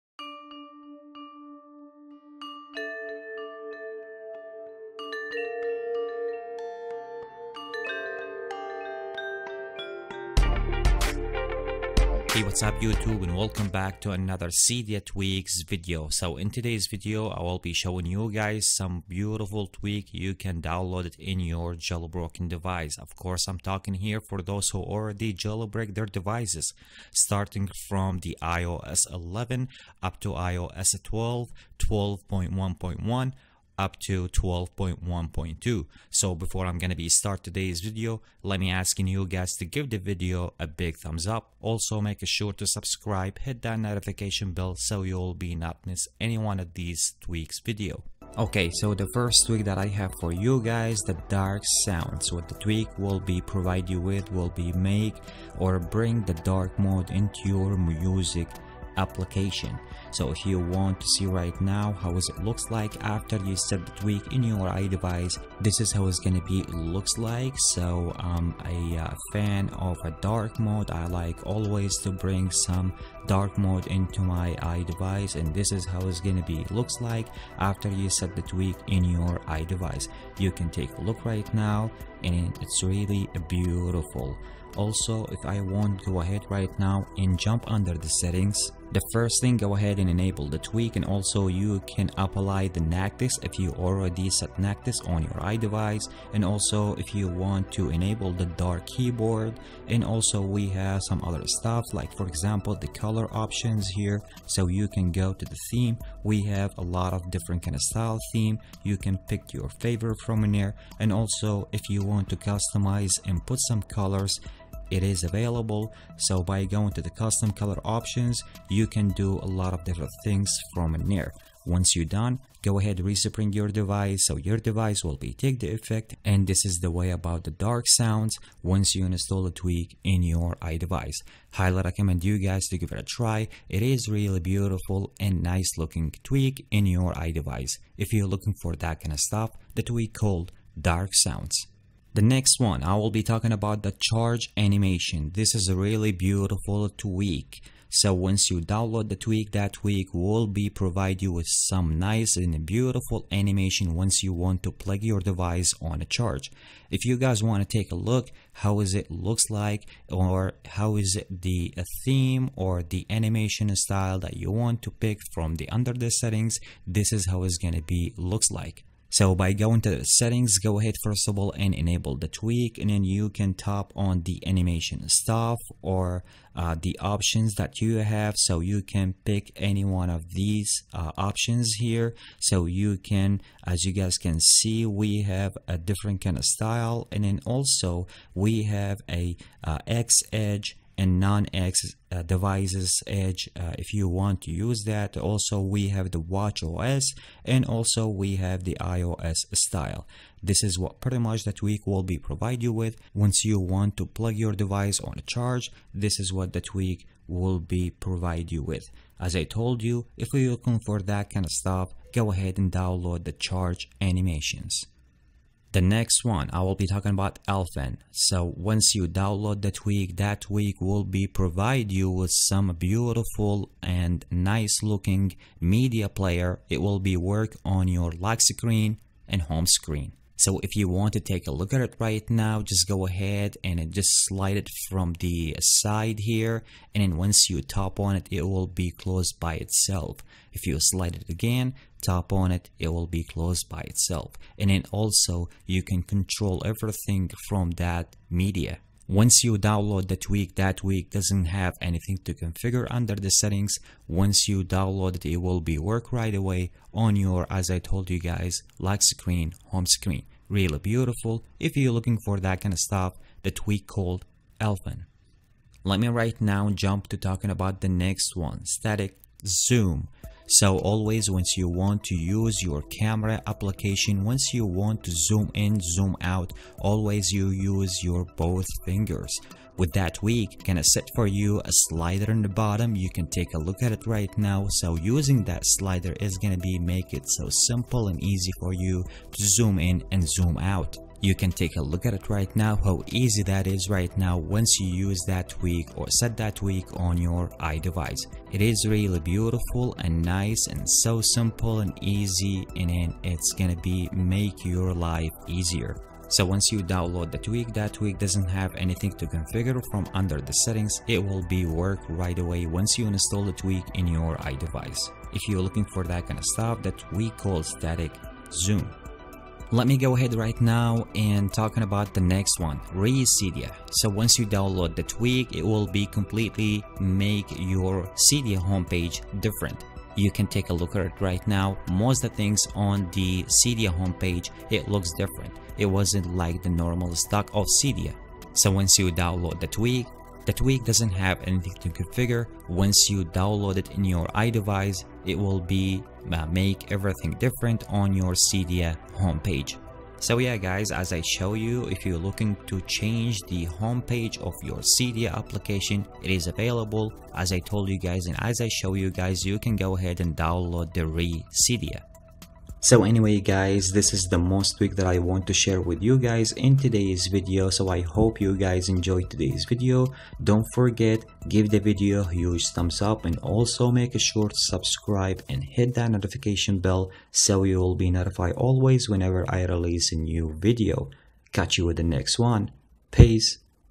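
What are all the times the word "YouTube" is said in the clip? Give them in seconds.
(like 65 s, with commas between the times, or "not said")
12 s.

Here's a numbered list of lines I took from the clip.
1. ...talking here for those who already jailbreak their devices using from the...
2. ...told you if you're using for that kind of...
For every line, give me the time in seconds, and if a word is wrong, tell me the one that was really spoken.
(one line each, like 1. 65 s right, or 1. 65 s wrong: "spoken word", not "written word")
1. 23 s wrong: "starting", not "using"
2. 209 s wrong: "looking", not "using".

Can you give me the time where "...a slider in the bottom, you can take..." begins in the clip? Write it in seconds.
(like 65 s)
281 s.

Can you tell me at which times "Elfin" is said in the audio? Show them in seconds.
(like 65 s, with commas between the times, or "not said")
217 s, 264 s.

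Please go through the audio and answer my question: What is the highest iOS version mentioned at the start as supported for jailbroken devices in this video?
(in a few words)
12.1.2.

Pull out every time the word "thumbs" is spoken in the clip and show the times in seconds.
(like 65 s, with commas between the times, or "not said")
40 s, 372 s.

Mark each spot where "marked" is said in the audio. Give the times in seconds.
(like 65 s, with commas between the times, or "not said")
not said.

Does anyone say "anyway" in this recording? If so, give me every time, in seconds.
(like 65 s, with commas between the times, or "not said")
363 s.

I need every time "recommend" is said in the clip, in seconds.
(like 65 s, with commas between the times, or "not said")
131 s.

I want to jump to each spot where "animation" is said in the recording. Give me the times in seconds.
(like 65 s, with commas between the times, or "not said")
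144 s, 153 s, 163 s, 174 s, 214 s.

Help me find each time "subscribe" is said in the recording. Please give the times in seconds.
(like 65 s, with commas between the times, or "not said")
42 s, 374 s.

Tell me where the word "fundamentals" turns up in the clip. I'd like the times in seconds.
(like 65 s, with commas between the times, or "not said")
not said.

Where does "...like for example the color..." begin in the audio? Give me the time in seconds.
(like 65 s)
101 s.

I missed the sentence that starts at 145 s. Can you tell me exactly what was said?
This is a really beautiful tweak.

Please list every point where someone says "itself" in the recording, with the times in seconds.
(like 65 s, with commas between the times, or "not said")
239 s, 243 s.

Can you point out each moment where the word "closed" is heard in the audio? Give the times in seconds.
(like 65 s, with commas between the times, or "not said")
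238 s, 243 s.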